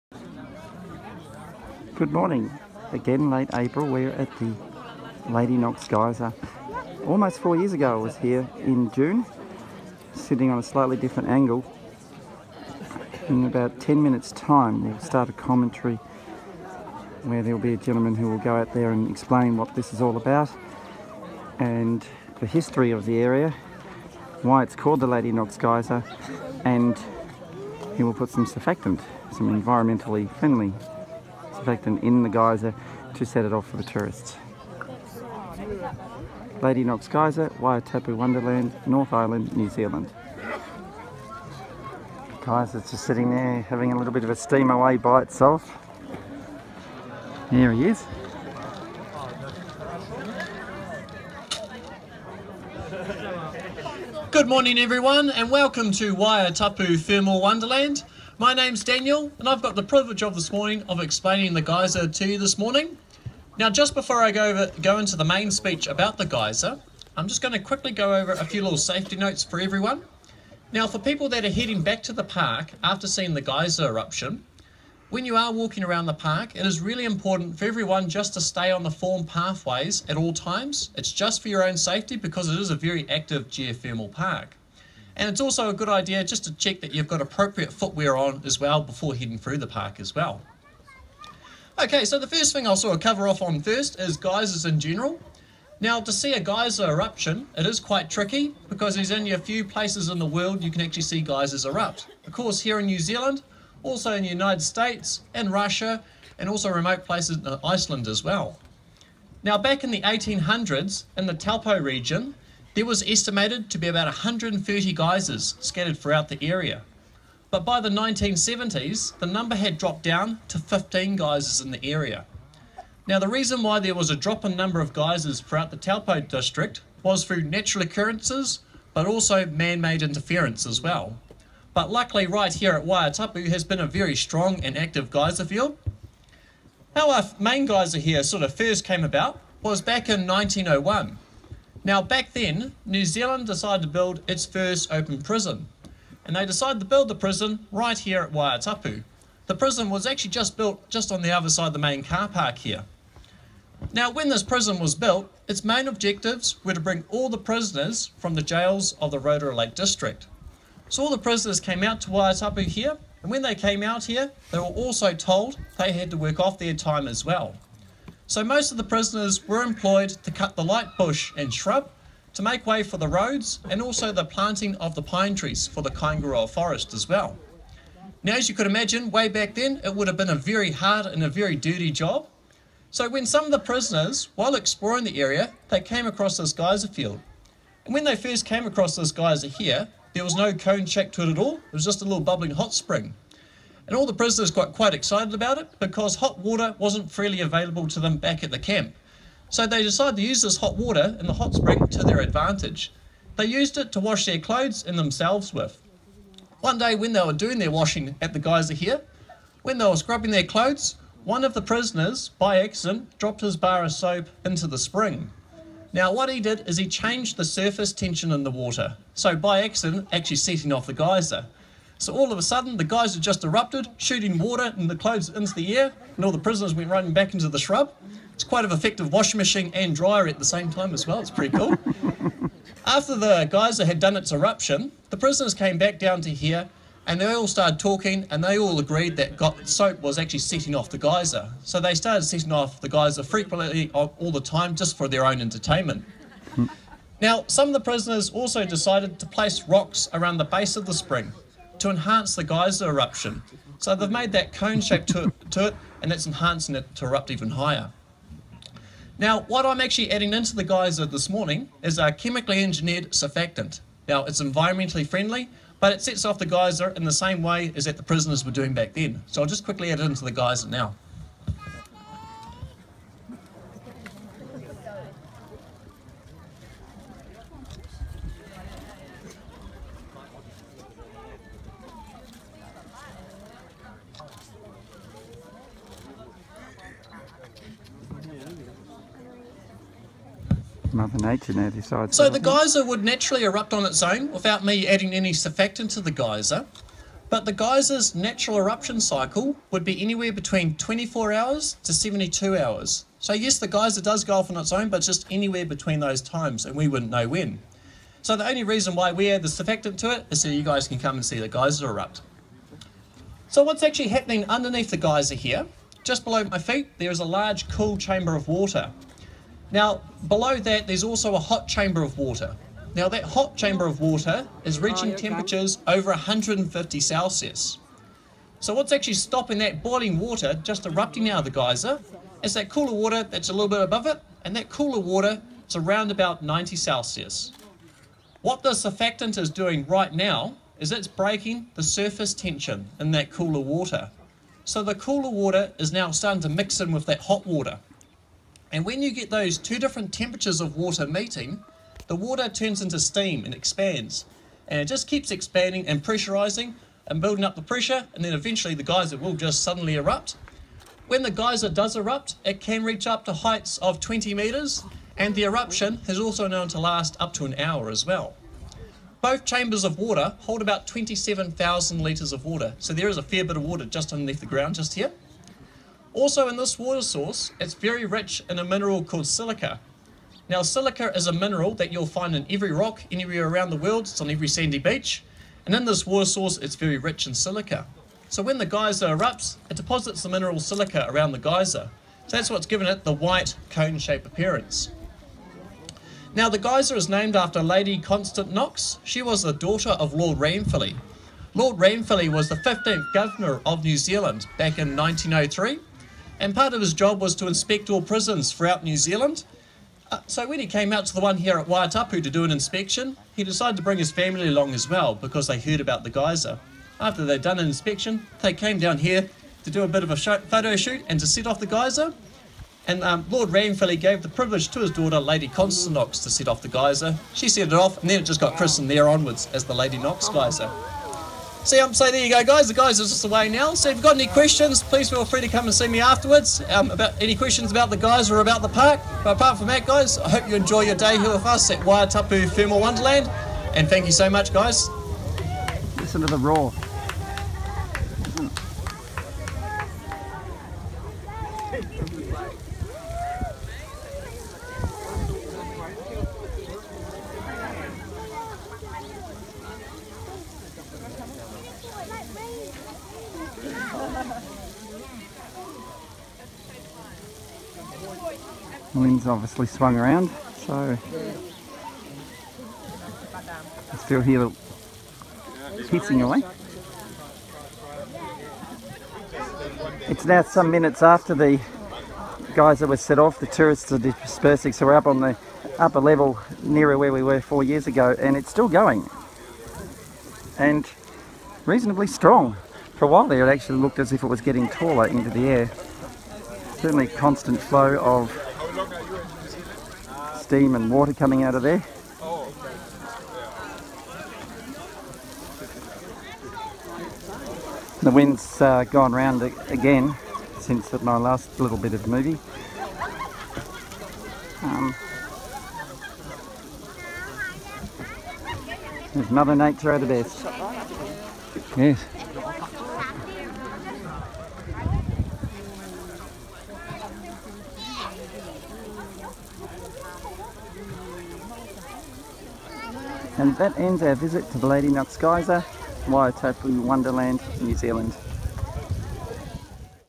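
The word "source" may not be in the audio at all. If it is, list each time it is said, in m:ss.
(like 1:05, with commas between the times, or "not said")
6:17, 6:26.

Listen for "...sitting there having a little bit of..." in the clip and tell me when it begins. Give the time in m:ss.
0:43.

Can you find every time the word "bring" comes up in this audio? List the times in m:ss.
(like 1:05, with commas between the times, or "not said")
2:36, 6:53.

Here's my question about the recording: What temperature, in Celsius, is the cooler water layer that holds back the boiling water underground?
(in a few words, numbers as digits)
90 Celsius.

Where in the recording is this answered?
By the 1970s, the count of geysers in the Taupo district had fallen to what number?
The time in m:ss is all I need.
2:00.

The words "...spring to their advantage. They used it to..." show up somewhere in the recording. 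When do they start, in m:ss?
3:21.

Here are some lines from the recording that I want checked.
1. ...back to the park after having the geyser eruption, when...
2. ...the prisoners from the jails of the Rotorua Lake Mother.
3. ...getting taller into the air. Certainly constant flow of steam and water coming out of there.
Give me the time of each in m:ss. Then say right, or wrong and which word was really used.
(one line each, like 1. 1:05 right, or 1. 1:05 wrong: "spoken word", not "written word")
1. 1:11 wrong: "seeing", not "having"
2. 2:37 wrong: "District", not "Mother"
3. 8:14 right.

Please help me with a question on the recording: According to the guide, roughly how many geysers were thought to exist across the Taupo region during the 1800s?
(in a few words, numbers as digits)
130.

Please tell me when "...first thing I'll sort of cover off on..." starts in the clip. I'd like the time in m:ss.
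1:32.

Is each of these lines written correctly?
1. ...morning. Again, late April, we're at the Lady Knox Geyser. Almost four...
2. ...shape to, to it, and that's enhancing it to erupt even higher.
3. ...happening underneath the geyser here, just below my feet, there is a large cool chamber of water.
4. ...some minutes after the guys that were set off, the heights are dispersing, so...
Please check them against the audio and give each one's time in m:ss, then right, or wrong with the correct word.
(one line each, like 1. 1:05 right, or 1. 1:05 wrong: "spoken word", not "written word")
1. 0:02 right
2. 4:14 right
3. 5:14 right
4. 8:00 wrong: "tourists", not "heights".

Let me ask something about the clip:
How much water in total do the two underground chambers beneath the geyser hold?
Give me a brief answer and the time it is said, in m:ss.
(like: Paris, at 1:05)
27,000 litres, at 6:10.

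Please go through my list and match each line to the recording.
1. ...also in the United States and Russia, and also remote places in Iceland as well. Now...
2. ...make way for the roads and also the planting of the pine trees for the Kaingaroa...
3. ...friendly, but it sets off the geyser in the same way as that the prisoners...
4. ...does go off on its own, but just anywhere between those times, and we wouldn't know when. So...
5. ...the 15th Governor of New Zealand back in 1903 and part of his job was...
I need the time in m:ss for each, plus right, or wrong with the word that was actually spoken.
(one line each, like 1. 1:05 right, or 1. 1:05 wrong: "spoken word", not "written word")
1. 1:43 right
2. 2:52 right
3. 4:25 right
4. 5:04 right
5. 6:42 right.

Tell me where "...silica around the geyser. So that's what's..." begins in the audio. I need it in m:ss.
6:30.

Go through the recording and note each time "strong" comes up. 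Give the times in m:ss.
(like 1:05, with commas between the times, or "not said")
2:14, 8:12.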